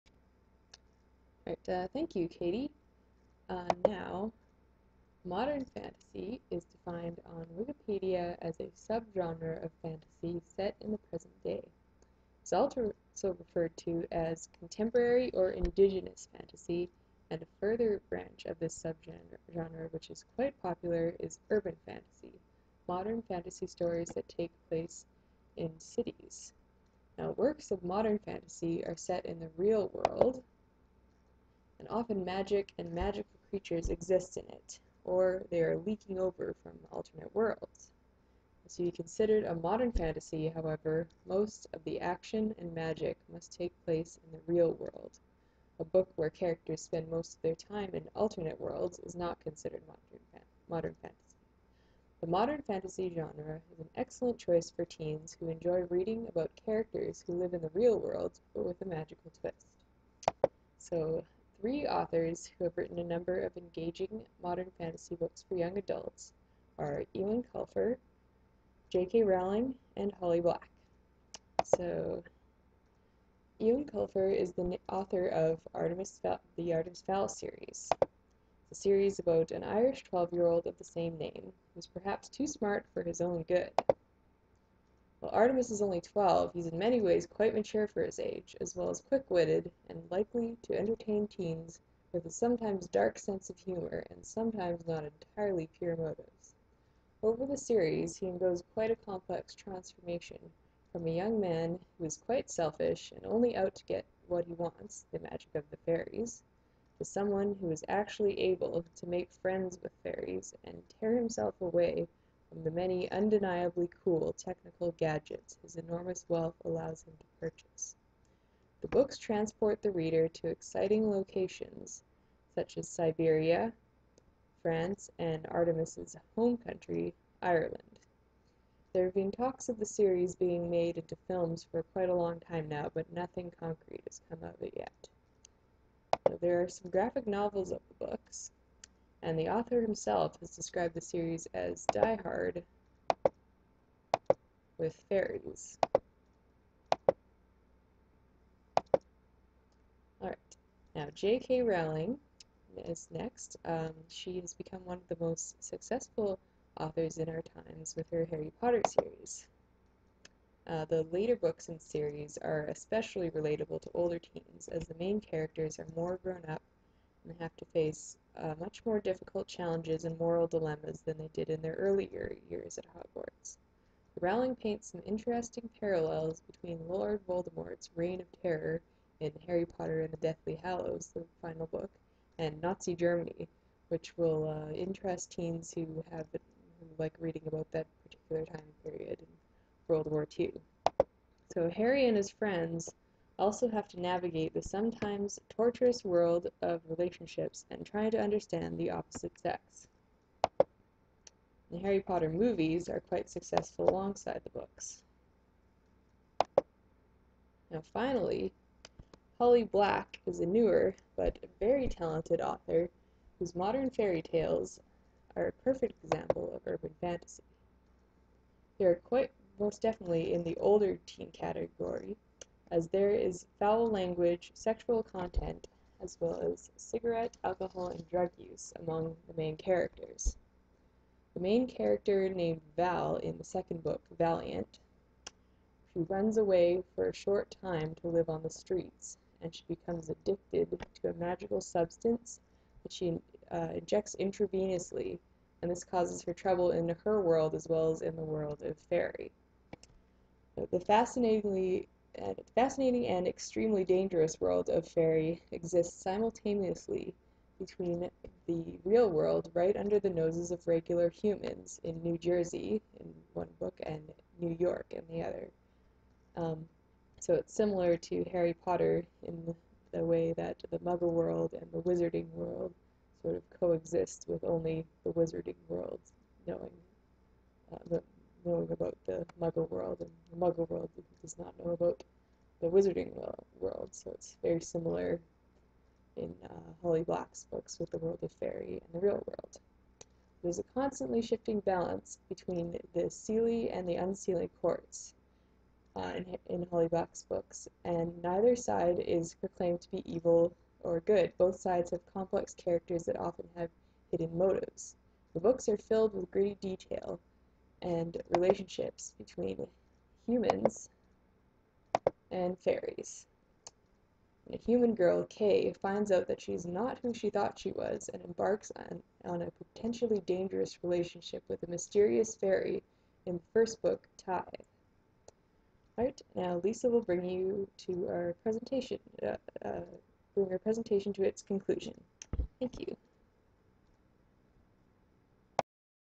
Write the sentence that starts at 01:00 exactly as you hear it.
So three authors who have written a number of engaging modern fantasy books for young adults are Eoin Colfer, J.K.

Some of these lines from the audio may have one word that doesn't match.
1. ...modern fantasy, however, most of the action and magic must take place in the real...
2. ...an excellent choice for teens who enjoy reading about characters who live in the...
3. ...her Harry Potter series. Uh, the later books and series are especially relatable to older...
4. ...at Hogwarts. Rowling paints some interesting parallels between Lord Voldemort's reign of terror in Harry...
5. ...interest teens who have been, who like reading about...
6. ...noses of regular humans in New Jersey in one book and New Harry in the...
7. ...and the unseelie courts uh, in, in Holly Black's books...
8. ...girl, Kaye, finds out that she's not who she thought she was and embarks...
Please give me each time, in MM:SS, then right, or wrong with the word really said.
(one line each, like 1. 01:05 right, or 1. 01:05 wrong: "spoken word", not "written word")
1. 00:39 right
2. 00:53 right
3. 02:38 right
4. 02:52 right
5. 03:04 right
6. 04:20 wrong: "York", not "Harry"
7. 04:53 right
8. 05:14 right.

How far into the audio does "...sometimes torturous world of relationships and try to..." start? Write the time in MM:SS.
03:14.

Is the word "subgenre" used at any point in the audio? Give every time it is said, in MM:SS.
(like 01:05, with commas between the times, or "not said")
00:08, 00:18.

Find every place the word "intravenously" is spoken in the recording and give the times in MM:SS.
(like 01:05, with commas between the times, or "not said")
04:04.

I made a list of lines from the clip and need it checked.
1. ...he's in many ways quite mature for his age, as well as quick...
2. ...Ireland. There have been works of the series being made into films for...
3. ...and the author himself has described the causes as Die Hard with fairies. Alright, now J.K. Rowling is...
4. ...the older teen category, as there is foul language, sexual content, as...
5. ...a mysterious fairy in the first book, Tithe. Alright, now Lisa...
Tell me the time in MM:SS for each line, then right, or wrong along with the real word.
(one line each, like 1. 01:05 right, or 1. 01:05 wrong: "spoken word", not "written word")
1. 01:26 right
2. 02:07 wrong: "talks", not "works"
3. 02:19 wrong: "series", not "causes"
4. 03:40 right
5. 05:21 right.